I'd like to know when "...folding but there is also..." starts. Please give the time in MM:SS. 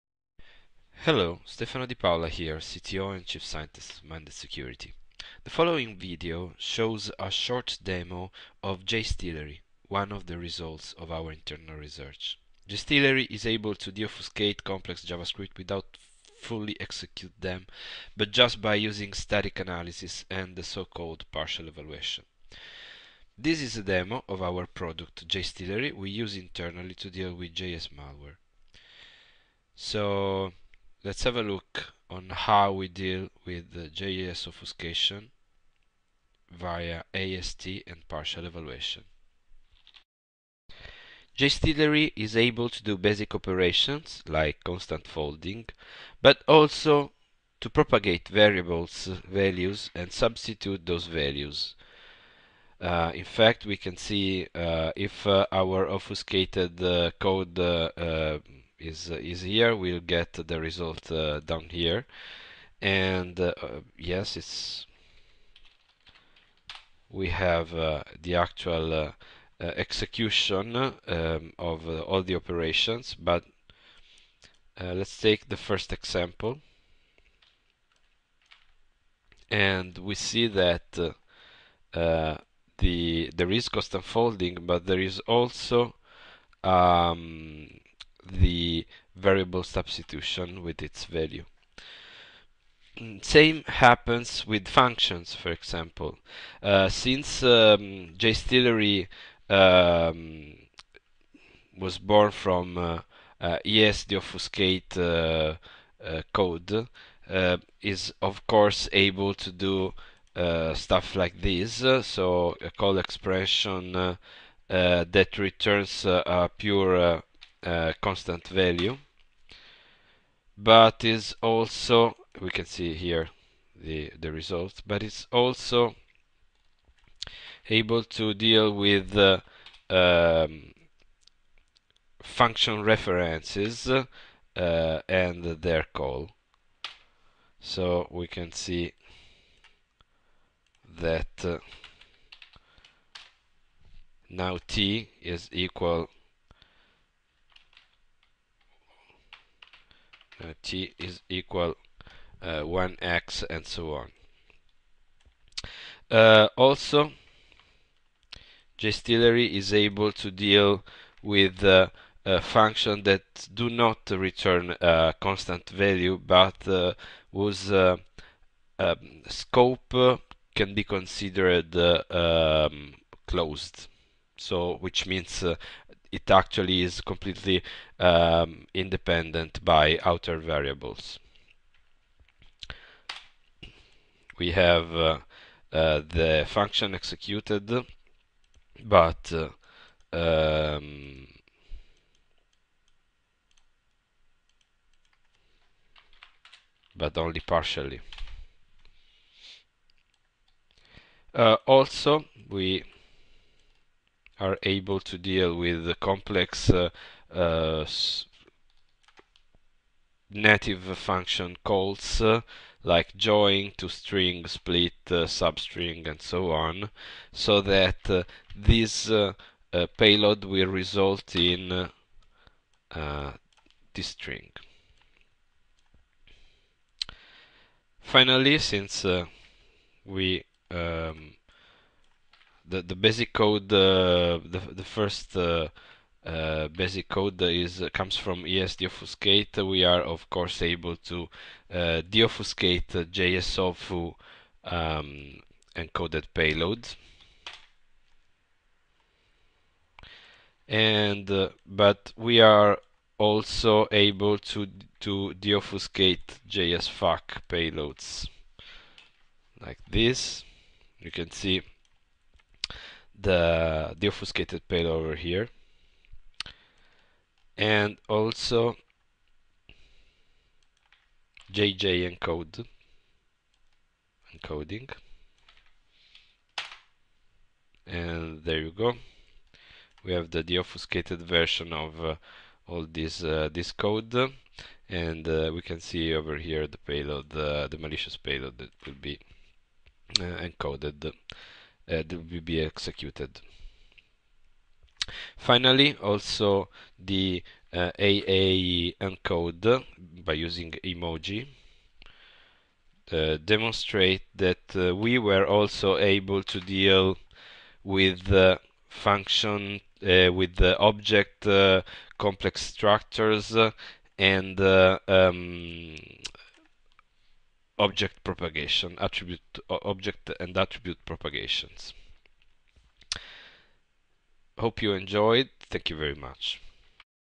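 01:24.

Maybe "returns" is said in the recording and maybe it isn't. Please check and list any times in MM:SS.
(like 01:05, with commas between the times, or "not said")
01:55, 02:44.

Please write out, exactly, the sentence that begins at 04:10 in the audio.
And but we are also able to to deobfuscate JSFuck payloads like this.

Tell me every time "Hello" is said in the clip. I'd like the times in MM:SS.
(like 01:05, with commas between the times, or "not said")
00:01.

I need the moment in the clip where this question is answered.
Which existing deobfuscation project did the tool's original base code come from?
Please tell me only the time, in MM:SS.
03:58.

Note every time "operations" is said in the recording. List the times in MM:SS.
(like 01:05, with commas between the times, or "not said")
00:43, 01:12.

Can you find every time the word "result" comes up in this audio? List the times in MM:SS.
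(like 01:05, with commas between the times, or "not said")
00:10, 01:00, 02:04, 03:40.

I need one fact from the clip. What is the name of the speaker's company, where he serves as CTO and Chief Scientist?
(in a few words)
Minded Security.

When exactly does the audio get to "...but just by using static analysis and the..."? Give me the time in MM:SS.
00:18.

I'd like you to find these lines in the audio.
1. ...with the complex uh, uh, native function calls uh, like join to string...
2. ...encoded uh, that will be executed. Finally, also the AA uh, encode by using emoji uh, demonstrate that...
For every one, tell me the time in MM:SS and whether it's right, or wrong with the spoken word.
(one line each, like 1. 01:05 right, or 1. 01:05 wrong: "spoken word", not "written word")
1. 03:25 right
2. 04:50 right.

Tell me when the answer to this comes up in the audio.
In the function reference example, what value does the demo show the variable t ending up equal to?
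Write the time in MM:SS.
02:32.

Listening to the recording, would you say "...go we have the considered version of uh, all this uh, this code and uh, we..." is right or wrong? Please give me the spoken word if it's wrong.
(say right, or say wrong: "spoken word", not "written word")
wrong: "deobfuscated", not "considered".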